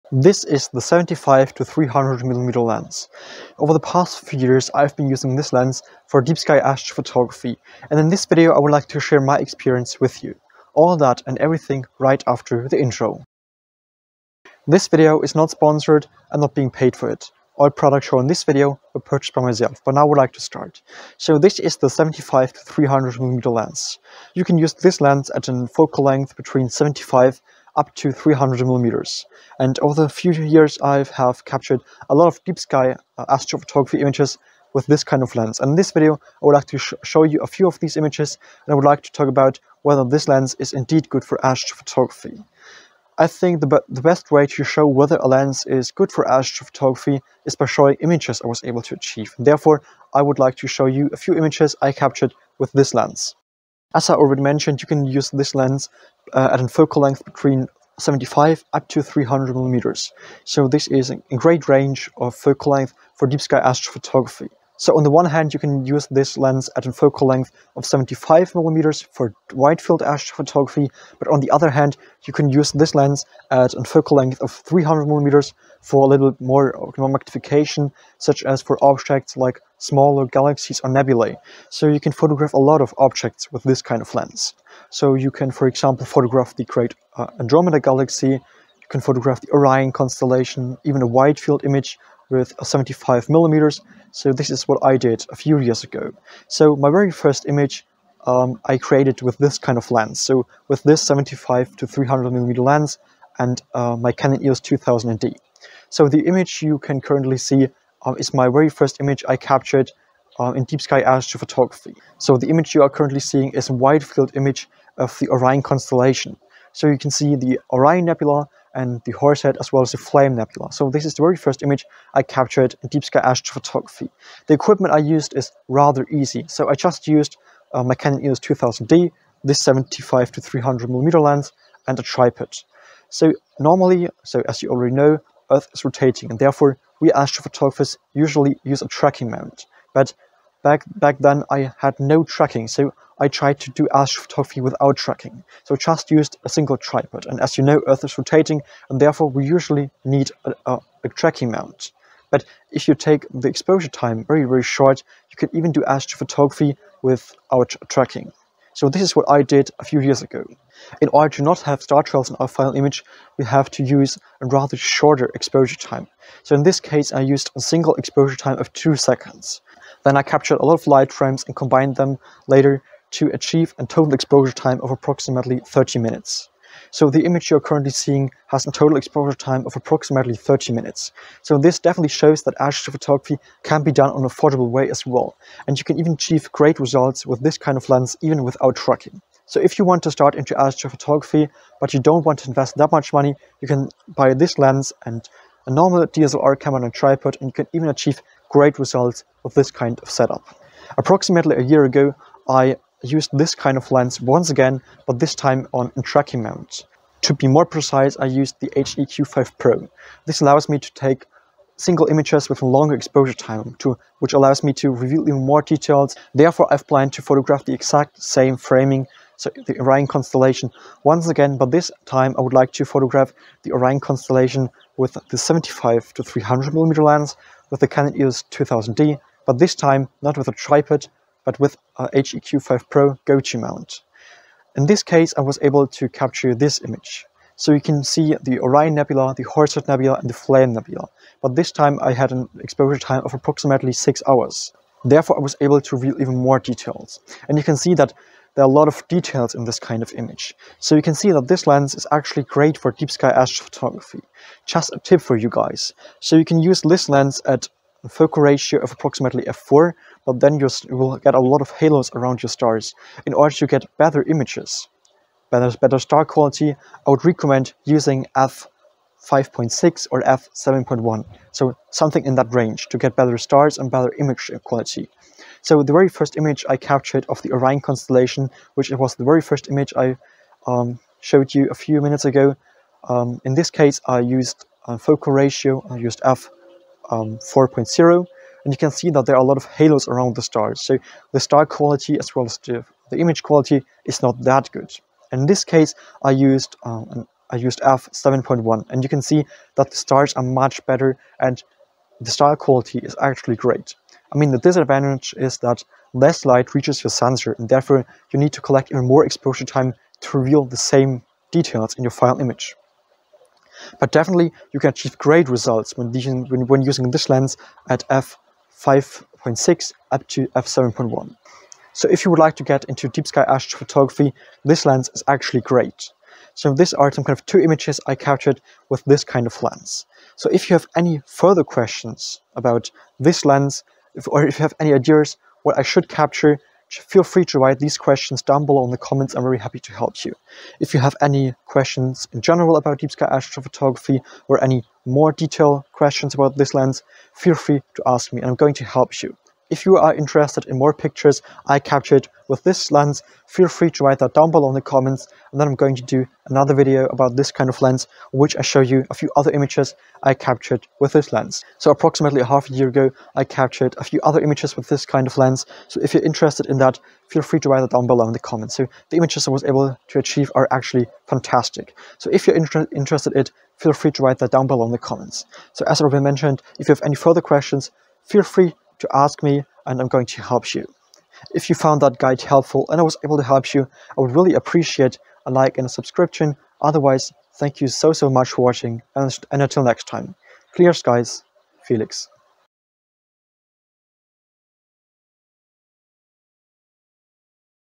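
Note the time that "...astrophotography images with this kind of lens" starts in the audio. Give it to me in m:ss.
0:33.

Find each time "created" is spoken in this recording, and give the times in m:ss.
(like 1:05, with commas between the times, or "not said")
1:38.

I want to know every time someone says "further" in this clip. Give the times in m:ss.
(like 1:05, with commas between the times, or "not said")
5:31, 6:17.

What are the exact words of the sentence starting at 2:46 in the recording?
So in this case, I used a single exposure time of 2 seconds.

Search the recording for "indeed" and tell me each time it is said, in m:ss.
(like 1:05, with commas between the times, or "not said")
0:40.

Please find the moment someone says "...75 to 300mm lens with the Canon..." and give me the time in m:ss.
3:45.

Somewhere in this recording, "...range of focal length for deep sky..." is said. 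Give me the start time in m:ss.
1:01.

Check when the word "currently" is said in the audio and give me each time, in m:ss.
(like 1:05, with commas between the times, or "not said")
1:47, 1:52, 2:57.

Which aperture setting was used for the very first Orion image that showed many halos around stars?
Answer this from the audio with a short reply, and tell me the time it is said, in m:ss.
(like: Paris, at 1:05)
f4.0, at 4:47.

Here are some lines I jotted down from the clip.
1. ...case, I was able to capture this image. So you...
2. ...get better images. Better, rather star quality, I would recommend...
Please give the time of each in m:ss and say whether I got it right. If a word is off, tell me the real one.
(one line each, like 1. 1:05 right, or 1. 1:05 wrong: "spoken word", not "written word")
1. 3:55 right
2. 4:23 wrong: "better", not "rather".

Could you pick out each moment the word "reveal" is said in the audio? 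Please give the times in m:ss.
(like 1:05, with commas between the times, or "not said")
3:34, 4:05, 5:10.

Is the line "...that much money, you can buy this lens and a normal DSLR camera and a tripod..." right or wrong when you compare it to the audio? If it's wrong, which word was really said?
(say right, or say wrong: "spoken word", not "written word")
right.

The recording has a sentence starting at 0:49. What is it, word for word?
And therefore, I would like to show you a few images I captured with this lens.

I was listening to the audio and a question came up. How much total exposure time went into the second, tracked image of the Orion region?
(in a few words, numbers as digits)
6 hours.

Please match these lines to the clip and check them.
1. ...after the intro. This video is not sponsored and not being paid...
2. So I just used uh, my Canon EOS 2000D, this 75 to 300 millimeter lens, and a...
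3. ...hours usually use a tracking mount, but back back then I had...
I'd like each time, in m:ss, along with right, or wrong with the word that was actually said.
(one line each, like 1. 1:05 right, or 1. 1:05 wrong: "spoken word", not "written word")
1. 0:12 right
2. 2:06 right
3. 2:17 wrong: "astrophotographers", not "hours".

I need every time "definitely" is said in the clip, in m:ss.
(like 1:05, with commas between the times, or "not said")
3:01, 5:14.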